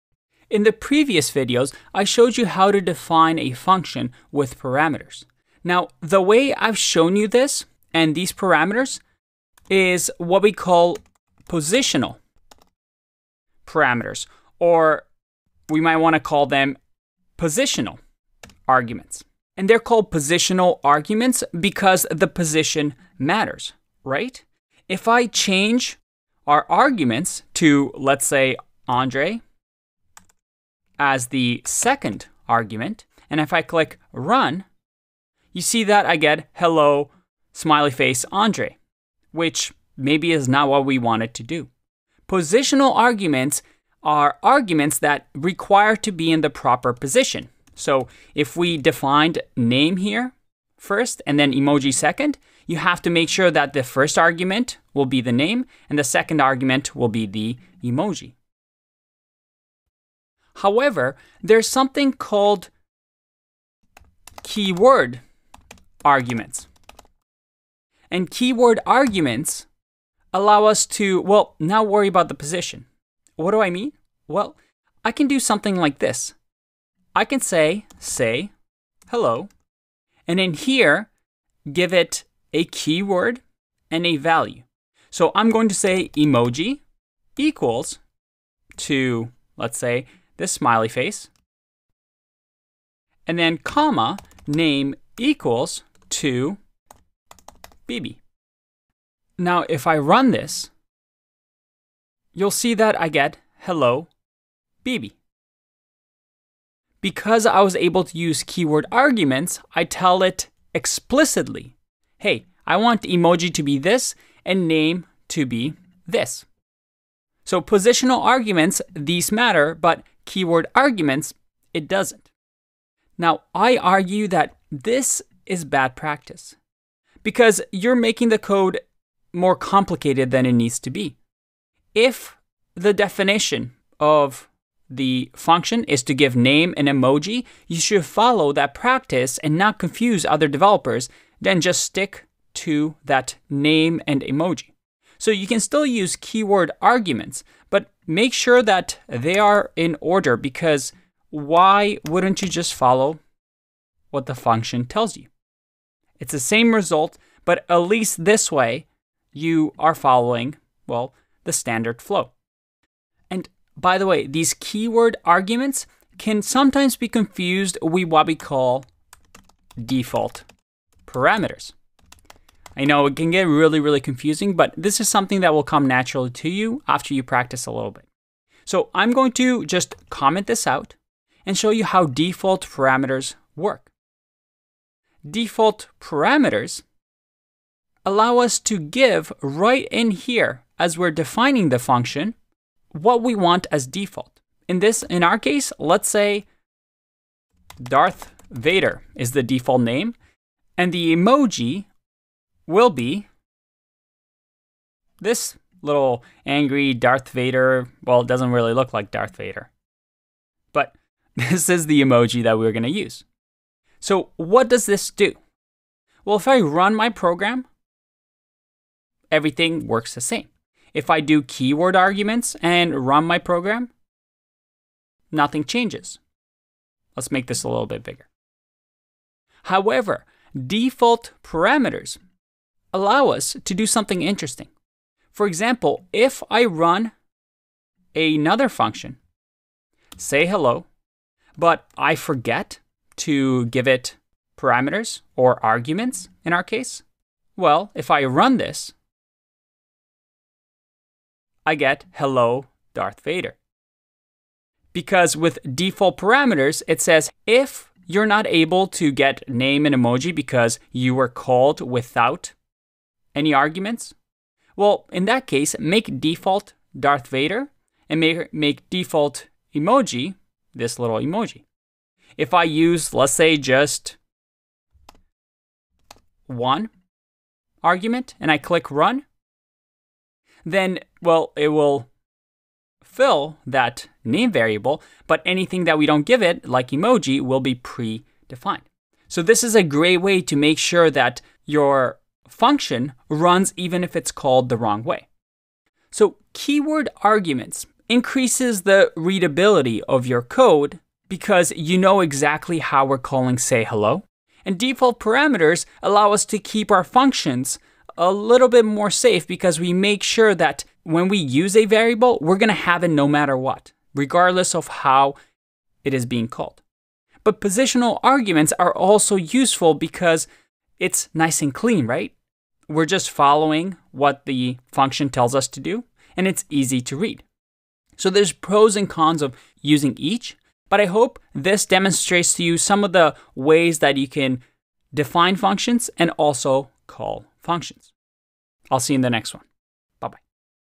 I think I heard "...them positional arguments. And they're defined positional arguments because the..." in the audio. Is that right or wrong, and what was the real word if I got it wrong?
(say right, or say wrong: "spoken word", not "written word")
wrong: "called", not "defined".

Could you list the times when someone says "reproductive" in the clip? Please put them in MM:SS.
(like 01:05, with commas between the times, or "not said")
not said.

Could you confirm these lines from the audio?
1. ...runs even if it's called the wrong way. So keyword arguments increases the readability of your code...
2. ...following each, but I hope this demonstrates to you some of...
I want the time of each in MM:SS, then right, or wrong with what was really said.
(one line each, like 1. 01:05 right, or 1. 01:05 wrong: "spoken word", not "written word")
1. 04:53 right
2. 05:29 wrong: "using", not "following".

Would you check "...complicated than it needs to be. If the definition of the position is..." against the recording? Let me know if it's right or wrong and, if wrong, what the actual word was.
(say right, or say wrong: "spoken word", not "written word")
wrong: "function", not "position".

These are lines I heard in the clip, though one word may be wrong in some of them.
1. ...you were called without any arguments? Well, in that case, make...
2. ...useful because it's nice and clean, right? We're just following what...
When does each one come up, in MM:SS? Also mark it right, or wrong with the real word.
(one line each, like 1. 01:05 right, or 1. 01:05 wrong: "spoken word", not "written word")
1. 04:20 right
2. 05:19 right.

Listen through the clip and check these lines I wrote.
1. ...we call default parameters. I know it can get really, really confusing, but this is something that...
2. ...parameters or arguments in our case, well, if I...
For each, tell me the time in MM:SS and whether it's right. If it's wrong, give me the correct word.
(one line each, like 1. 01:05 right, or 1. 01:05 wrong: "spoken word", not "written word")
1. 02:48 right
2. 04:04 right.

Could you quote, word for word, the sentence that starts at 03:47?
Let's make this a little bit bigger.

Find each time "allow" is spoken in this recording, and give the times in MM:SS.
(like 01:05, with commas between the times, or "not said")
01:10, 03:08, 03:52, 05:06.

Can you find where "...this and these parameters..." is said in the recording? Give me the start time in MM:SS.
00:07.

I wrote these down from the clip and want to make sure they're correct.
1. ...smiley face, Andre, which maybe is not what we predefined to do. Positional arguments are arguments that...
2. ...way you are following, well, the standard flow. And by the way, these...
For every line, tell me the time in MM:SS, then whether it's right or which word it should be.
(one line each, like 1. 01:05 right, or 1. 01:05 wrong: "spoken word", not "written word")
1. 00:37 wrong: "wanted", not "predefined"
2. 02:38 right.